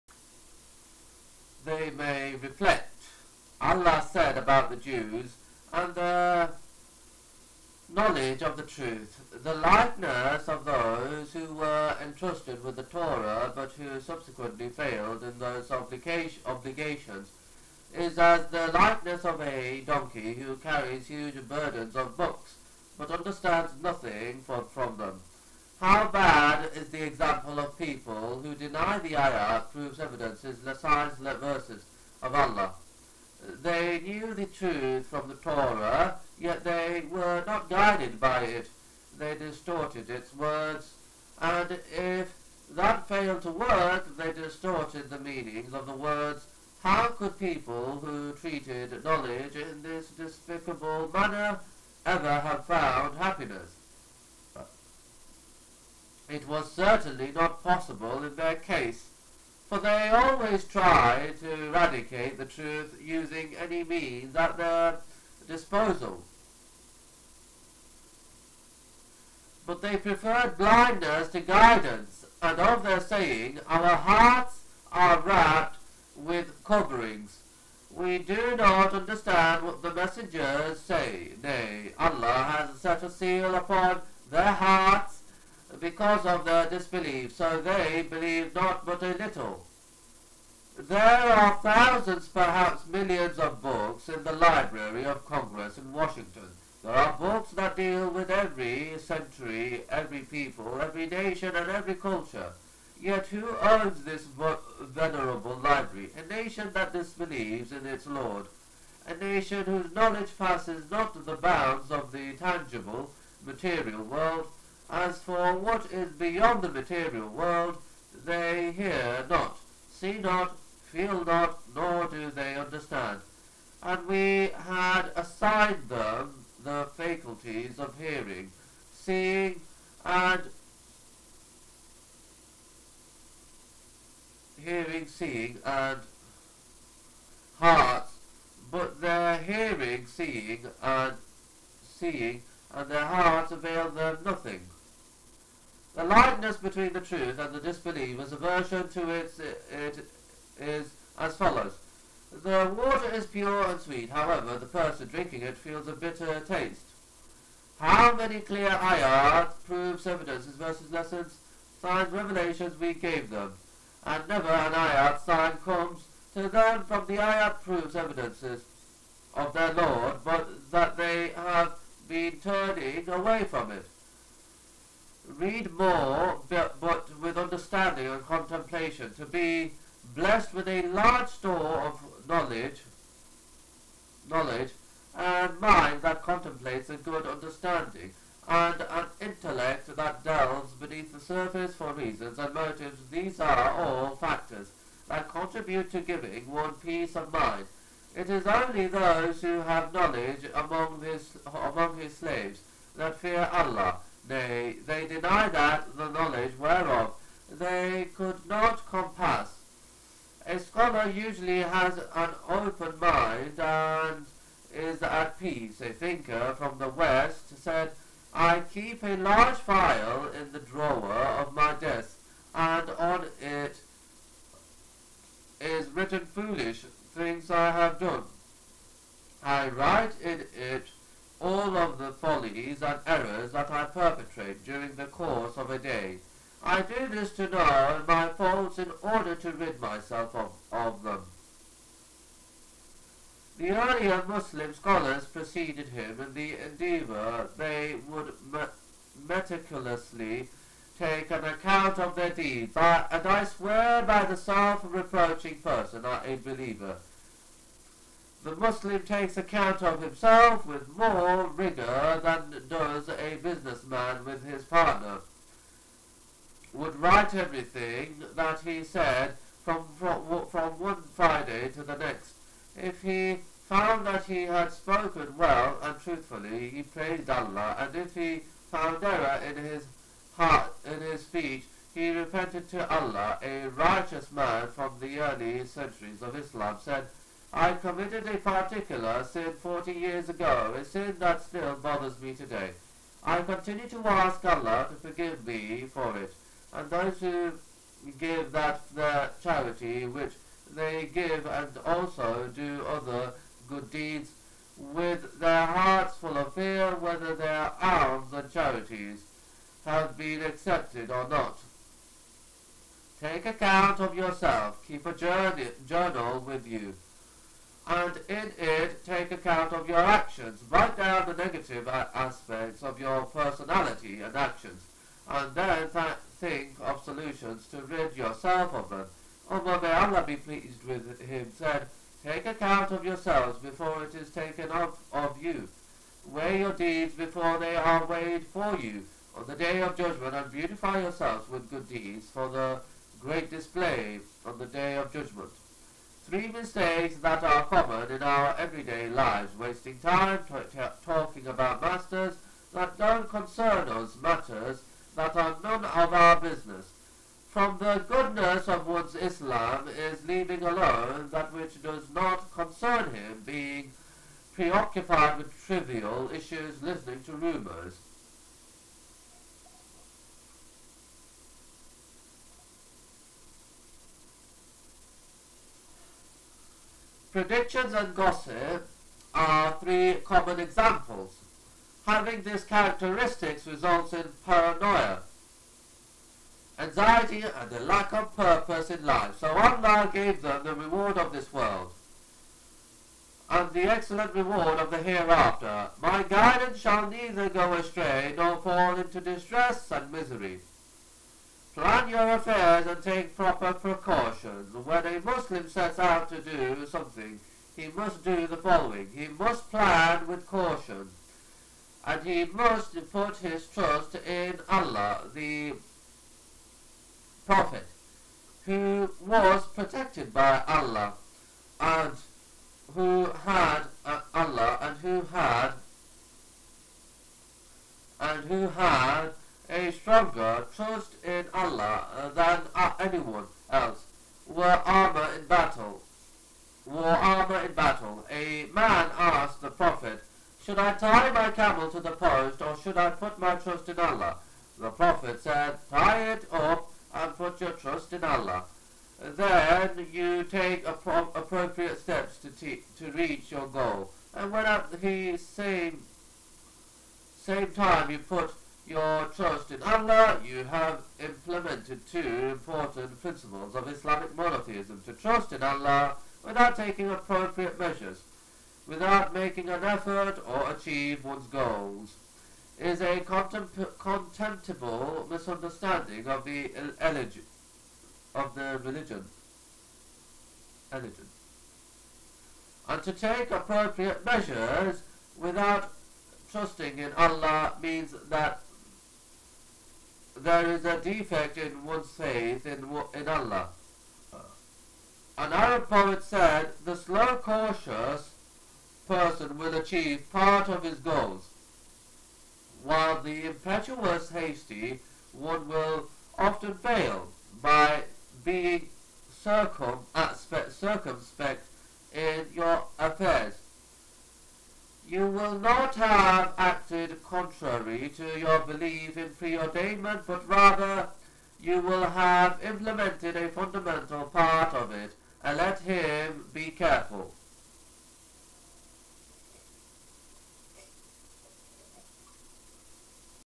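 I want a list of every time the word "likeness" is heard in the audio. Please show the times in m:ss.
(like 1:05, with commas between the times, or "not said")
0:09, 0:18, 2:26.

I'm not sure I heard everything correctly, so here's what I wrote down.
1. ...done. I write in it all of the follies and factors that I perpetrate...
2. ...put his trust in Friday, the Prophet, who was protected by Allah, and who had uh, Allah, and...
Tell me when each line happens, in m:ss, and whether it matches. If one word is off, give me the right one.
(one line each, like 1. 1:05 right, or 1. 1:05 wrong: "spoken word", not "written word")
1. 3:47 wrong: "errors", not "factors"
2. 6:53 wrong: "Allah", not "Friday".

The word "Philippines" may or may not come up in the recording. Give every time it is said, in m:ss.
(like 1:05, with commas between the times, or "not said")
not said.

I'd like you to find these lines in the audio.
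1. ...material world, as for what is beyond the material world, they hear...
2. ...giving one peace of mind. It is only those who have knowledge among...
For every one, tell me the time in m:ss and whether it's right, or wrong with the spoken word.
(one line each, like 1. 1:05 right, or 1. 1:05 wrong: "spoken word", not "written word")
1. 1:53 right
2. 3:16 right.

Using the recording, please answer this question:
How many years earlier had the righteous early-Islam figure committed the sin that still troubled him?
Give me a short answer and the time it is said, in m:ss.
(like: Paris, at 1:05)
40, at 4:49.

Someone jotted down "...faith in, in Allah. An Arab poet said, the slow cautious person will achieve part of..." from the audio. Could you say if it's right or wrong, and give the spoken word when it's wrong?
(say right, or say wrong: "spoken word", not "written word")
right.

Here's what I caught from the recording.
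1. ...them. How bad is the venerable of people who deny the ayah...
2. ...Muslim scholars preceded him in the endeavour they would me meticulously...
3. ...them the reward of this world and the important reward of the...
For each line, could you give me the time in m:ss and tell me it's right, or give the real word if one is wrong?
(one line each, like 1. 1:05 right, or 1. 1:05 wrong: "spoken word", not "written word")
1. 0:24 wrong: "example", not "venerable"
2. 4:04 right
3. 6:30 wrong: "excellent", not "important".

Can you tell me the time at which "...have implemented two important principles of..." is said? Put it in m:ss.
7:40.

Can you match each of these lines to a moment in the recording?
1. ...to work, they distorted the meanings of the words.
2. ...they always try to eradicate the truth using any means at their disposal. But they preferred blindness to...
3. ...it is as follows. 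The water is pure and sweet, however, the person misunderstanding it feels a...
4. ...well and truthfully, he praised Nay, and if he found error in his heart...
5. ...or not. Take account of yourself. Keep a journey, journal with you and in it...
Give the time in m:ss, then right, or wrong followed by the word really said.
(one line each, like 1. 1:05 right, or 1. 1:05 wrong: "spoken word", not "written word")
1. 0:43 right
2. 0:59 right
3. 2:29 wrong: "drinking", not "misunderstanding"
4. 4:35 wrong: "Allah", not "Nay"
5. 5:11 right.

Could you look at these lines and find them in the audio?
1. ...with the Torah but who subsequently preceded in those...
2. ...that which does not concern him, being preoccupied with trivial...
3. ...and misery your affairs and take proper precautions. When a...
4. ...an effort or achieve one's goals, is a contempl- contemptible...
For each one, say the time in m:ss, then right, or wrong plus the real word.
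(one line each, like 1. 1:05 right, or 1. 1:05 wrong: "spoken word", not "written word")
1. 0:12 wrong: "failed", not "preceded"
2. 6:01 right
3. 6:39 right
4. 7:49 right.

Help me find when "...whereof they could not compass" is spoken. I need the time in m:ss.
3:26.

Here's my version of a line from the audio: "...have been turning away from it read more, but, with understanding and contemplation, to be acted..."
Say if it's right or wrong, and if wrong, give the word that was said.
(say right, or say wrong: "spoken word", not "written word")
wrong: "blessed", not "acted".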